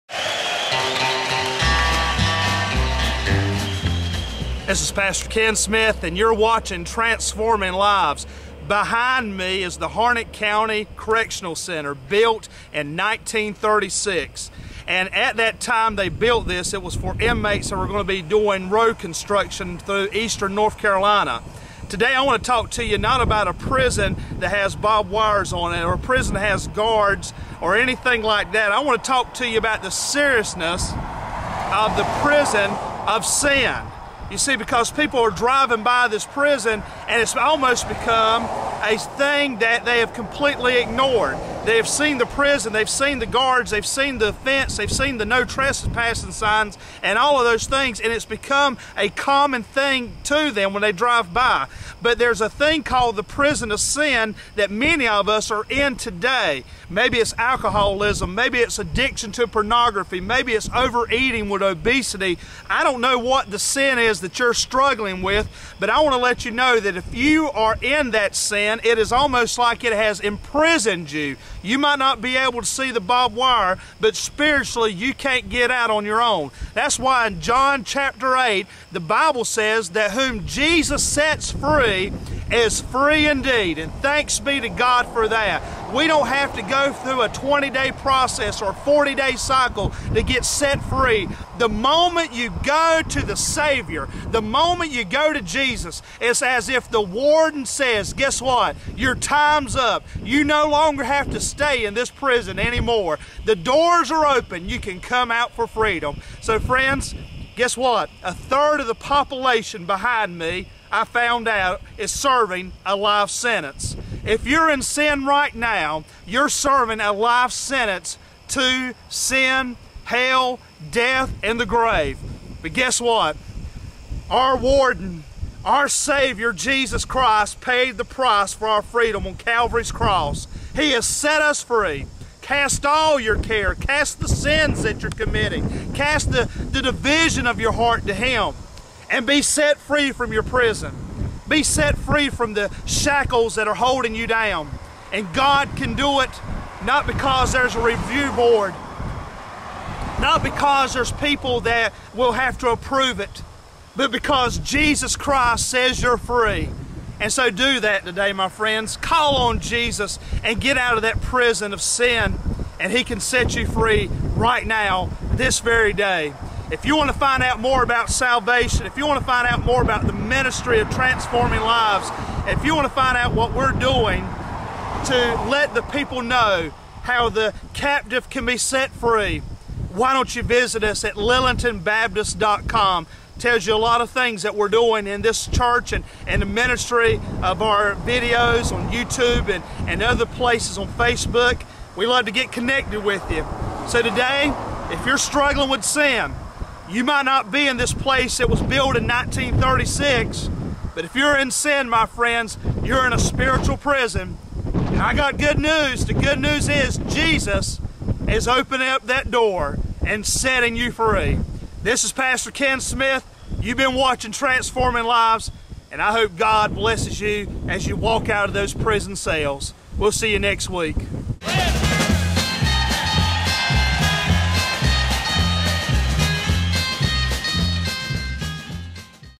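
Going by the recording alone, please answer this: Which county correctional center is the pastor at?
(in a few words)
Harnett County Correctional Center.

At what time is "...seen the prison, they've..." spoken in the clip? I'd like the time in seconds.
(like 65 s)
41 s.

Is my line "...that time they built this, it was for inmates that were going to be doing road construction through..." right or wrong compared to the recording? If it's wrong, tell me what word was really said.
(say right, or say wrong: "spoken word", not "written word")
right.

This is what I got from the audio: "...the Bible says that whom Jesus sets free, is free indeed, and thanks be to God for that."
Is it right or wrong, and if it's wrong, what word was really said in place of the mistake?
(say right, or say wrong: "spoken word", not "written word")
right.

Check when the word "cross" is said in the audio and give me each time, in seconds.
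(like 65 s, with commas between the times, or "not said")
129 s.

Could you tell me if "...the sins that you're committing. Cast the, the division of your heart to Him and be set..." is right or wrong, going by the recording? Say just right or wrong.
right.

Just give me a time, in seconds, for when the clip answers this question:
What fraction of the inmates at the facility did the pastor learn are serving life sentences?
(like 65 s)
108 s.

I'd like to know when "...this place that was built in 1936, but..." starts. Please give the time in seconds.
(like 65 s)
197 s.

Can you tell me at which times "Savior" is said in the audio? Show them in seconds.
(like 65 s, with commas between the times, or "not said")
93 s, 125 s.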